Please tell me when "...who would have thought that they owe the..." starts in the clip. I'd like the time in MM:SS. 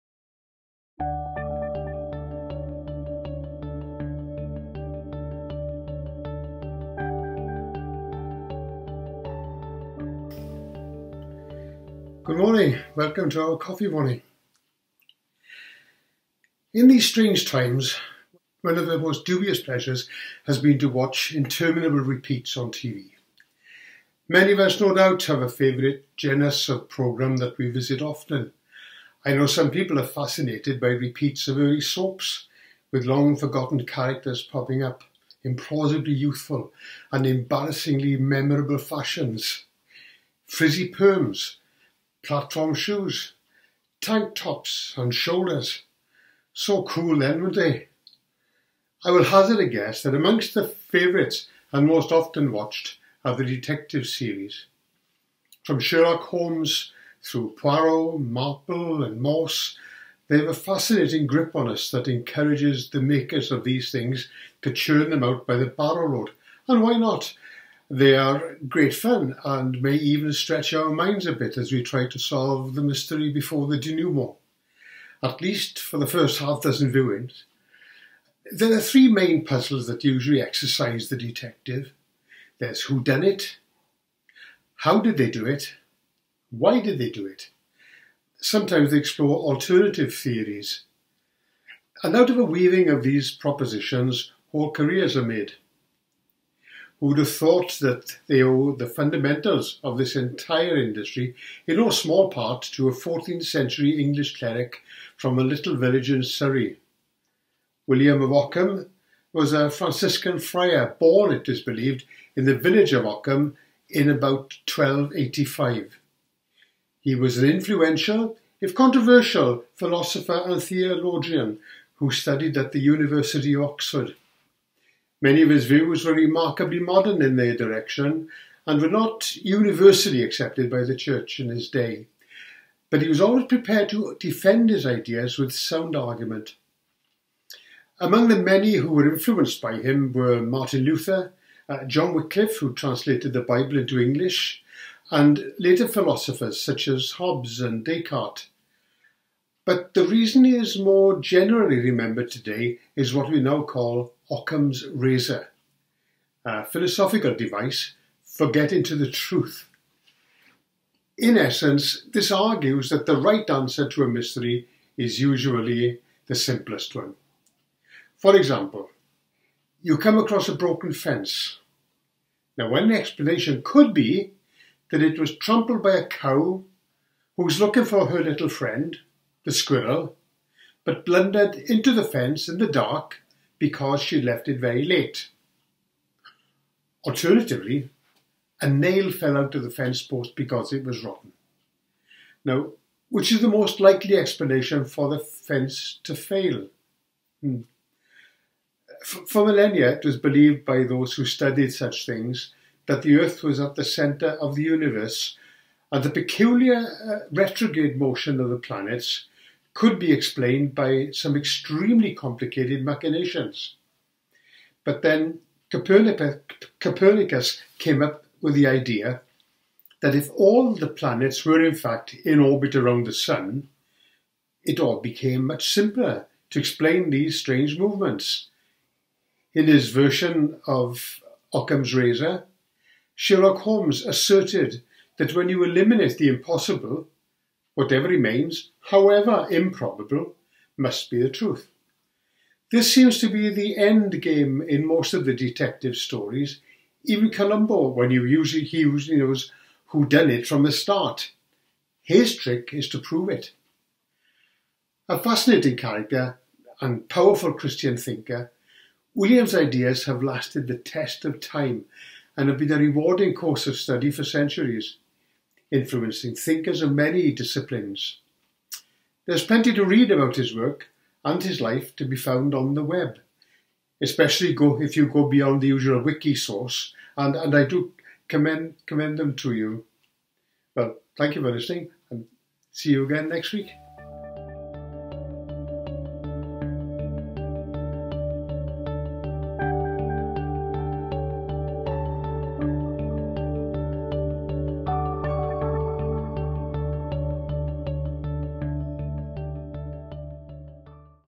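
01:37.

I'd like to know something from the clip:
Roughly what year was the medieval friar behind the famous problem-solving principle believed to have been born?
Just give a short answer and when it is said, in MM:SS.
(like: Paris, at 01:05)
1285, at 01:54.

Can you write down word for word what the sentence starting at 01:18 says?
There are three main puzzles that usually exercise the detective.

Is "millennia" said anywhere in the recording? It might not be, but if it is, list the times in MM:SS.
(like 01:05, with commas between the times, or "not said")
03:19.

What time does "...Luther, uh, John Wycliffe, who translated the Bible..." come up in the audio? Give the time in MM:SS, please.
02:20.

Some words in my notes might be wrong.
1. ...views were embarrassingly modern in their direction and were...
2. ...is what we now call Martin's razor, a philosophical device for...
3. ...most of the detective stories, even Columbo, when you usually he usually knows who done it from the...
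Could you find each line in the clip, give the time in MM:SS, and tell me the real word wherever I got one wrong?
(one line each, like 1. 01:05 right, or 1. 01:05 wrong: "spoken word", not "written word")
1. 02:05 wrong: "remarkably", not "embarrassingly"
2. 02:32 wrong: "Occam", not "Martin"
3. 04:04 right.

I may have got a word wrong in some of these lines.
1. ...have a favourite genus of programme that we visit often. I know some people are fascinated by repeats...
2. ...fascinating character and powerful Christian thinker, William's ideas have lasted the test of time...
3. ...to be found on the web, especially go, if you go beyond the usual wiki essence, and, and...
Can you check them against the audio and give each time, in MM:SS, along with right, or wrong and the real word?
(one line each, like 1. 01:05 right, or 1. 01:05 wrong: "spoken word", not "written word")
1. 00:25 right
2. 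04:15 right
3. 04:31 wrong: "source", not "essence".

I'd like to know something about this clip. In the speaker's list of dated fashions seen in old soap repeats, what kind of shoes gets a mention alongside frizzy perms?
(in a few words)
Platform shoes.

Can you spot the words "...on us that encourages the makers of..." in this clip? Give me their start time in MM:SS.
01:01.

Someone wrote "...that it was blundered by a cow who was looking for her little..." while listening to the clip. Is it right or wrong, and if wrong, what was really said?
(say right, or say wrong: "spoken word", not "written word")
wrong: "trampled", not "blundered".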